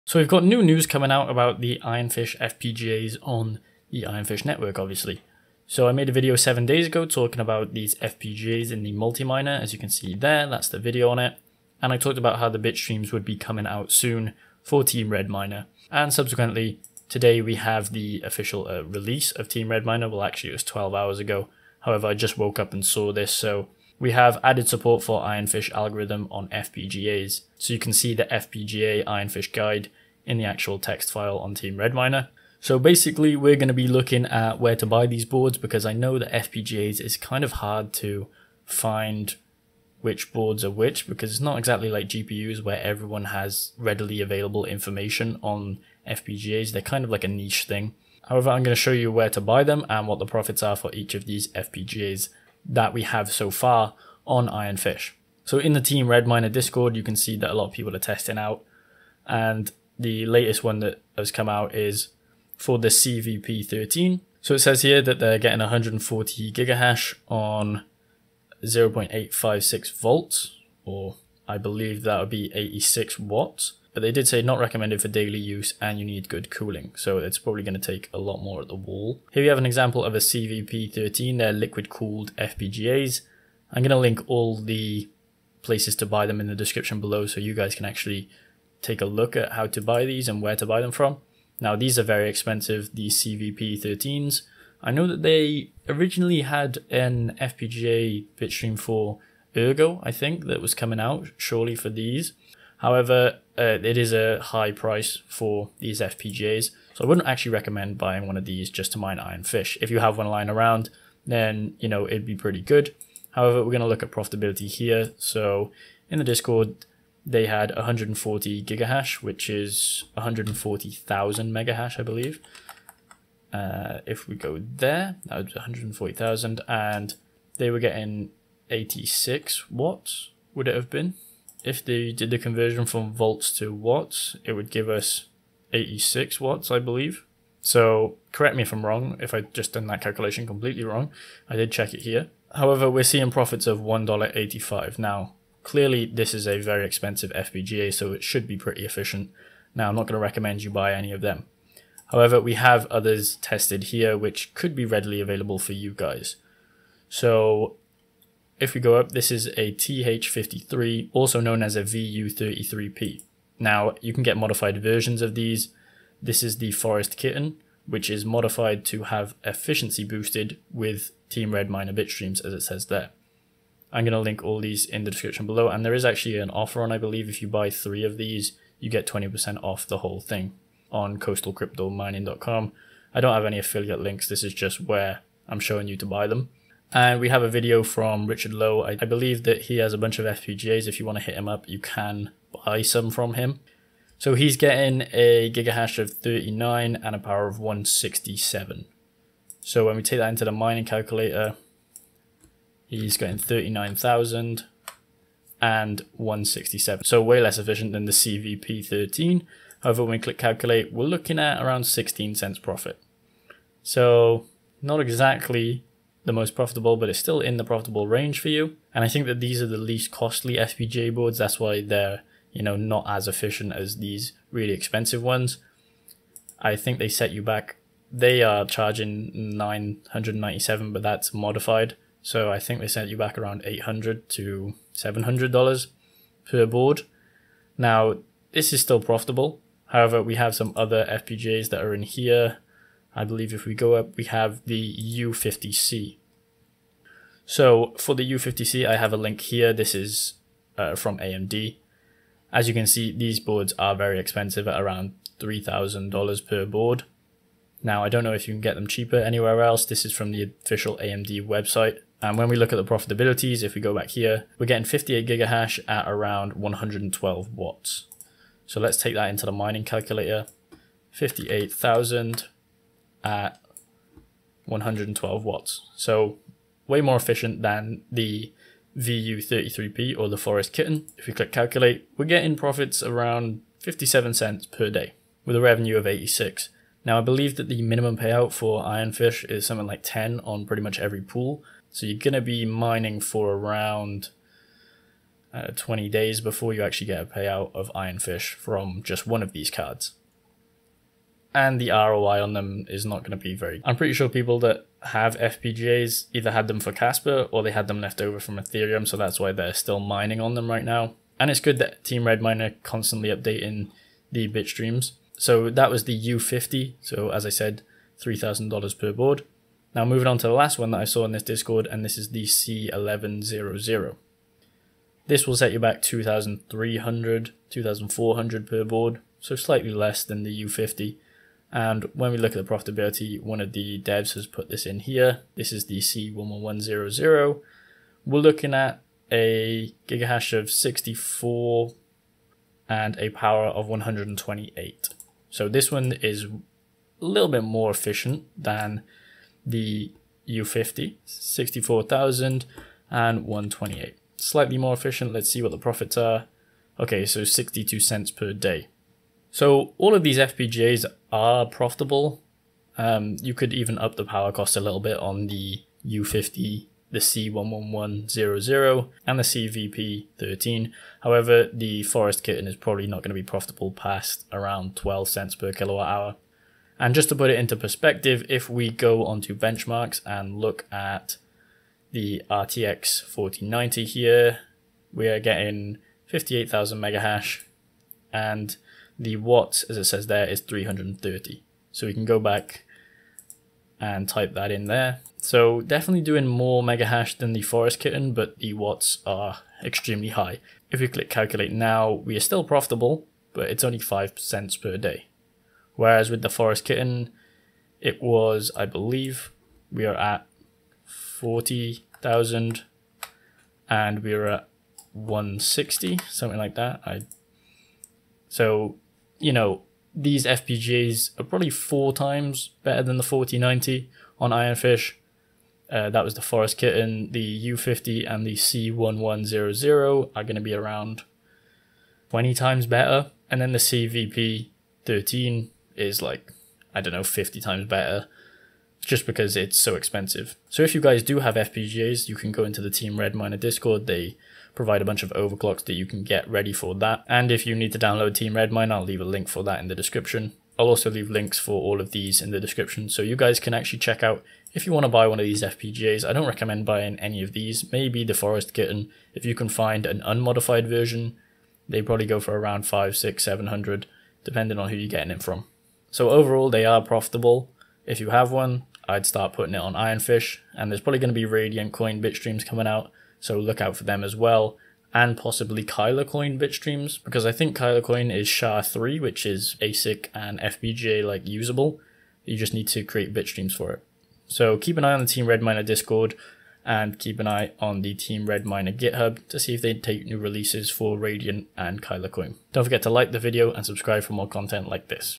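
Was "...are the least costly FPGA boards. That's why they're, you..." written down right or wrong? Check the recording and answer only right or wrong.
right.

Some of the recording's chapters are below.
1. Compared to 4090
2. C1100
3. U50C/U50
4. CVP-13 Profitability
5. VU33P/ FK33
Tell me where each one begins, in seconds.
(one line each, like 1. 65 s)
1. 378 s
2. 320 s
3. 240 s
4. 82 s
5. 155 s.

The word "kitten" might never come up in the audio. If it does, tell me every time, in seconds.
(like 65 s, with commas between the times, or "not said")
167 s, 280 s, 372 s, 397 s, 406 s, 426 s, 458 s.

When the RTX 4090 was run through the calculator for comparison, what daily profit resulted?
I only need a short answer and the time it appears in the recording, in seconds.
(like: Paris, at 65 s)
5 cents, at 403 s.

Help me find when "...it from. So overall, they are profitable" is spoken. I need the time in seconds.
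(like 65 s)
465 s.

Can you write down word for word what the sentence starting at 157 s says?
So if we go up, this is a TH53, also known as a VU33P.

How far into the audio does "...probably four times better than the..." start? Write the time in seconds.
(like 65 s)
421 s.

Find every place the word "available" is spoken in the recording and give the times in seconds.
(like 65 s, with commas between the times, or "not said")
44 s, 155 s.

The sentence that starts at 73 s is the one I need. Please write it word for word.
But they did say not recommended for daily use and you need good cooling.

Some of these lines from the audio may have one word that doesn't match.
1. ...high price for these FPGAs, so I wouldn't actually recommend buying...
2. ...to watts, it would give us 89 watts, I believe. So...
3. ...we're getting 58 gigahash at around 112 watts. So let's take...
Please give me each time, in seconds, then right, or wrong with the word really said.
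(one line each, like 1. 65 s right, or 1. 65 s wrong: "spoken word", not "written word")
1. 104 s right
2. 133 s wrong: "86", not "89"
3. 264 s right.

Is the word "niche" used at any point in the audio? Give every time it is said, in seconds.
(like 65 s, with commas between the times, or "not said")
47 s.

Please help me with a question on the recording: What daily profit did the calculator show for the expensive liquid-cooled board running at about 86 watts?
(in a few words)
$1.85.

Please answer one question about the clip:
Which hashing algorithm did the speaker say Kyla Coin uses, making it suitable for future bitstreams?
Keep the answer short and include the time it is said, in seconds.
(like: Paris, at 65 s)
SHA-3, at 478 s.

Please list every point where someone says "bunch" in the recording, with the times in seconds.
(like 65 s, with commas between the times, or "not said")
189 s, 445 s.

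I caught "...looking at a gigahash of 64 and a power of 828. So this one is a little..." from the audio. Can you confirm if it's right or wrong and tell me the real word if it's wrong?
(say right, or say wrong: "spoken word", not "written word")
wrong: "128", not "828".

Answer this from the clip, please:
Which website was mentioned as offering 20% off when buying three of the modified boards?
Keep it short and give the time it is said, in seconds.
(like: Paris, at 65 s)
coastalcryptomining.com, at 181 s.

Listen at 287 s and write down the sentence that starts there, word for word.
Now I believe that the minimum payout for Ironfish is something like 10 on pretty much every pool.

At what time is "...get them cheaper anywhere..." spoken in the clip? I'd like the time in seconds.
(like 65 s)
258 s.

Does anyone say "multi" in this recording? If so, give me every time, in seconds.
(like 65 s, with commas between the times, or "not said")
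8 s.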